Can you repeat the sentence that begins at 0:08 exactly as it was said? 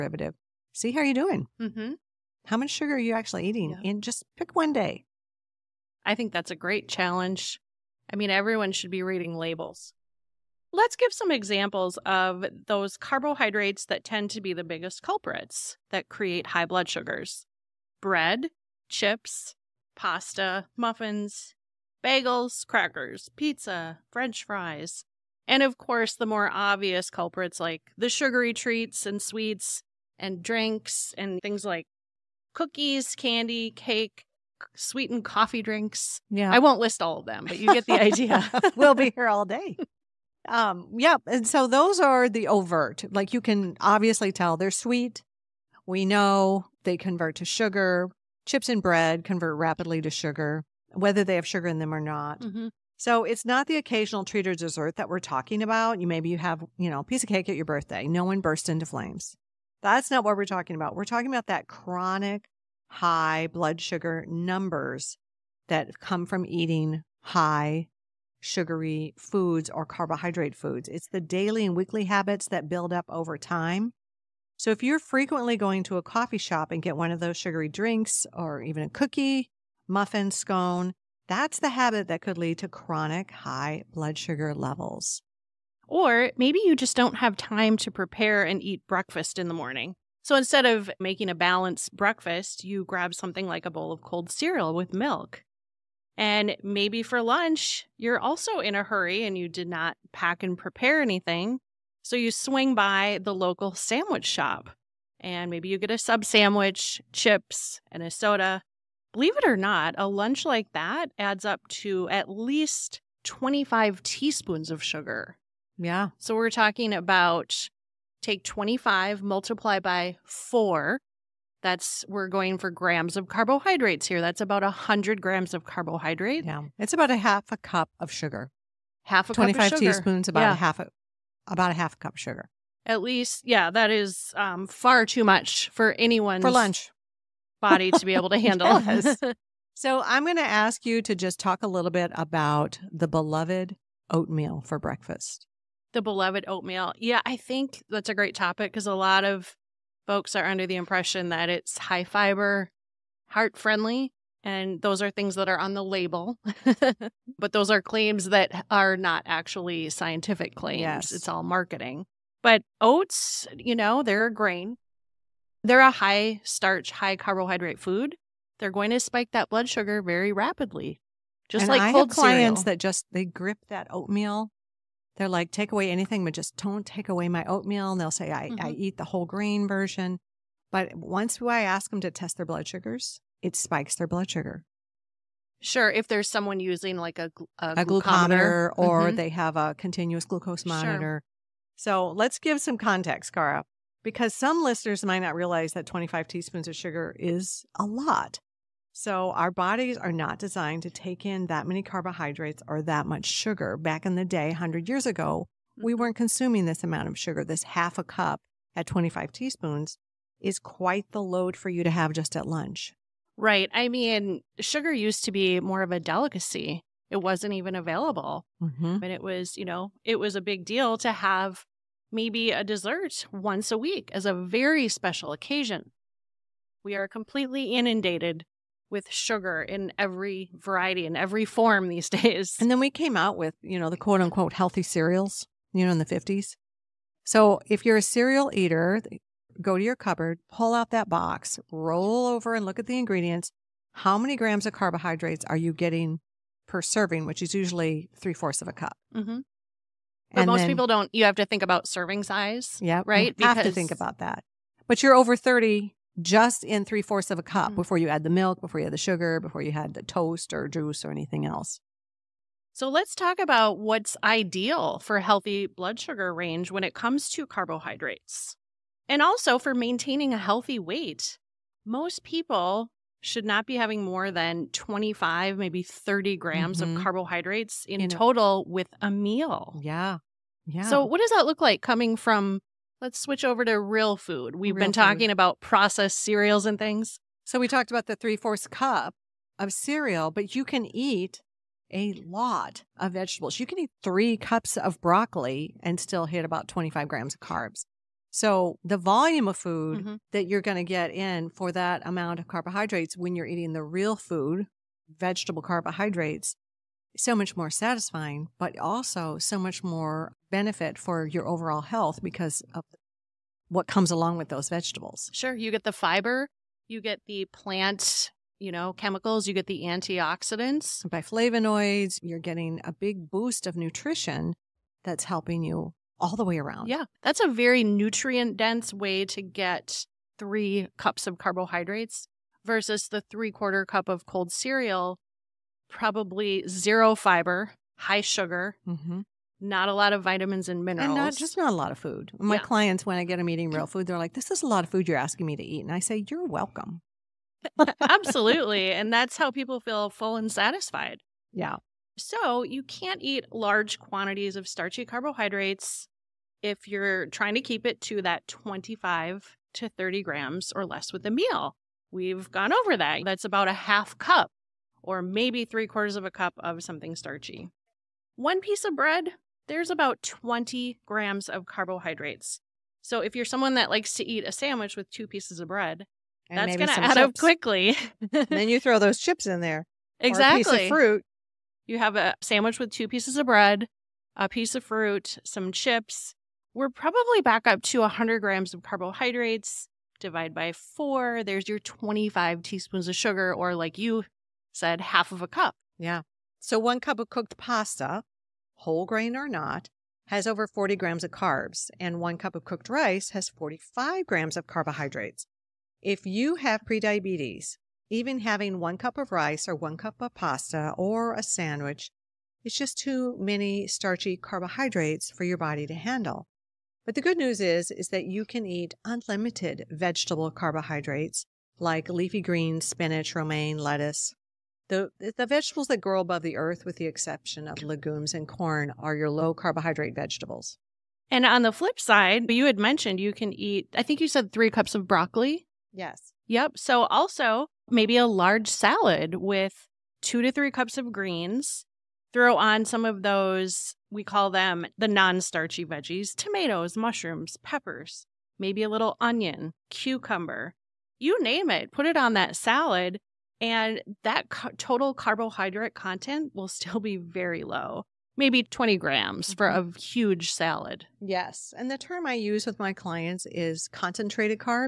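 I mean, everyone should be reading labels.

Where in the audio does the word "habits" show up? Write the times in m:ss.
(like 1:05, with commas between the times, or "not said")
1:12, 1:21.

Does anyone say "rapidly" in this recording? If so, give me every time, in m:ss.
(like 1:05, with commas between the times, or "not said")
0:49, 2:50.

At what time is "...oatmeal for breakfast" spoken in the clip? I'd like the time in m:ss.
2:24.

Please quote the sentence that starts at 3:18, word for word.
So our bodies are not designed to take in that many carbohydrates or that much sugar.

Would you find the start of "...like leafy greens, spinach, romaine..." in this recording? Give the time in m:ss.
7:01.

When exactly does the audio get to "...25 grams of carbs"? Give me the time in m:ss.
4:56.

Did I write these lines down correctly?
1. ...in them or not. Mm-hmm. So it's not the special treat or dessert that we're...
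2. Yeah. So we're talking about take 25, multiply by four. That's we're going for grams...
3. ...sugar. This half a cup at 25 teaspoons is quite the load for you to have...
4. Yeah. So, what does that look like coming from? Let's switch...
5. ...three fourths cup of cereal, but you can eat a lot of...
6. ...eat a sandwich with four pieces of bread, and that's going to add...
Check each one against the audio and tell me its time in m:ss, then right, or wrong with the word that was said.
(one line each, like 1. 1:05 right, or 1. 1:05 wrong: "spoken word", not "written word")
1. 0:51 wrong: "occasional", not "special"
2. 1:55 right
3. 3:27 right
4. 4:40 right
5. 4:48 right
6. 6:14 wrong: "two", not "four".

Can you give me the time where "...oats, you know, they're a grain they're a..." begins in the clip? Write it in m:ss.
2:42.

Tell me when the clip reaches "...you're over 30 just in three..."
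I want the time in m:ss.
4:15.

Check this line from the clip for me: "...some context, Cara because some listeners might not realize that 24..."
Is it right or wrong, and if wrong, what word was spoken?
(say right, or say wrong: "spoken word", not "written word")
wrong: "25", not "24".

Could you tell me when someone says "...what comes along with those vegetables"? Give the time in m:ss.
5:13.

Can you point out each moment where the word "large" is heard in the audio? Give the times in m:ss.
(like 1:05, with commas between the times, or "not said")
5:53, 7:18.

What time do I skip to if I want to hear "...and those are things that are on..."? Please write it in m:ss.
2:34.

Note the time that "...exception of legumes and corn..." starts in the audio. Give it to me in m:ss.
7:07.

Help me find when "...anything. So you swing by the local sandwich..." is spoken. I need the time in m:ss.
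1:41.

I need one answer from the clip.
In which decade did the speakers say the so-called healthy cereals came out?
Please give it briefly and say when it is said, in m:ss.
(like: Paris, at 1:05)
the 50s, at 3:55.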